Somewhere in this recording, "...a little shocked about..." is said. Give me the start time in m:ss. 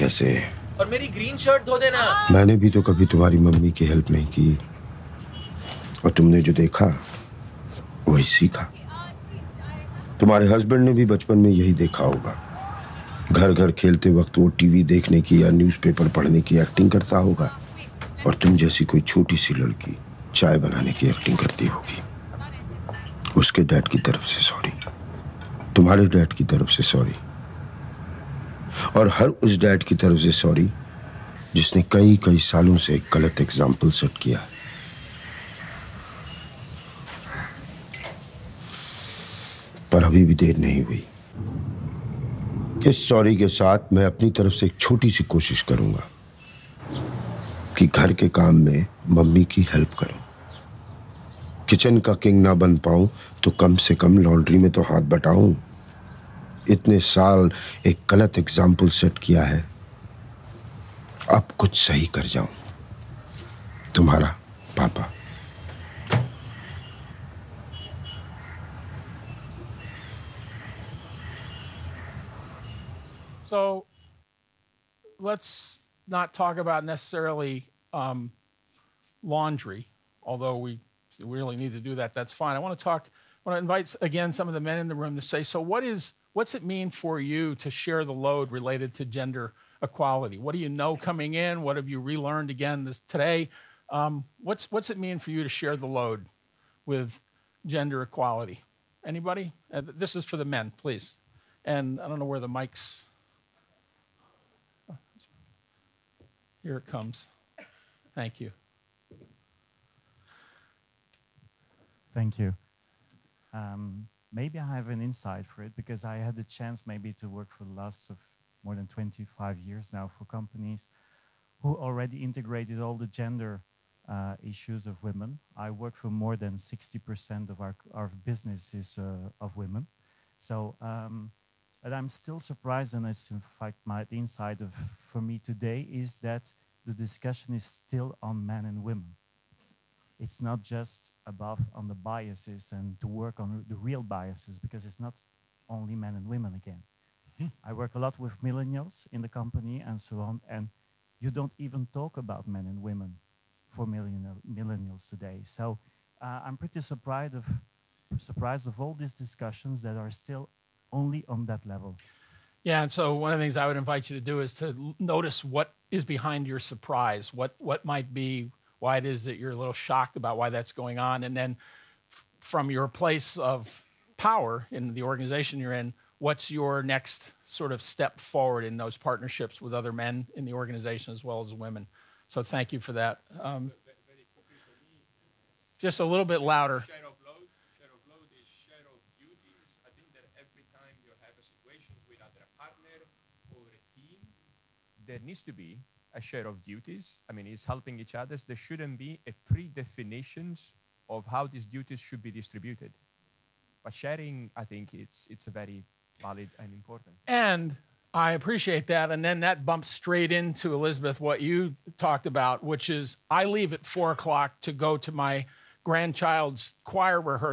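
2:49.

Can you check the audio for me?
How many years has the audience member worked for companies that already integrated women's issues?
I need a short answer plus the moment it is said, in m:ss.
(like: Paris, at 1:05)
More than 25 years, at 1:58.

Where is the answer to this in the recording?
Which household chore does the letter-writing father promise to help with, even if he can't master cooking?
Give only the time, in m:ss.
0:54.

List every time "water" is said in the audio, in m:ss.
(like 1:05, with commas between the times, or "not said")
not said.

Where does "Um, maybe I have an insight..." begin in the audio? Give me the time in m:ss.
1:53.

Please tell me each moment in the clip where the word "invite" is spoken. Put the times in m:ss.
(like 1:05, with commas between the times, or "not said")
1:23, 2:43.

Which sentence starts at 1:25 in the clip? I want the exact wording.
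So what is what's it mean for you to share the load related to gender equality?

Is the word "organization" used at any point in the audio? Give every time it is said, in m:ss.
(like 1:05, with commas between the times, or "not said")
2:55, 3:00.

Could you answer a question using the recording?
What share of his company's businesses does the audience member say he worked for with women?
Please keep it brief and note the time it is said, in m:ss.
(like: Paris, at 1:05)
More than 60%, at 2:06.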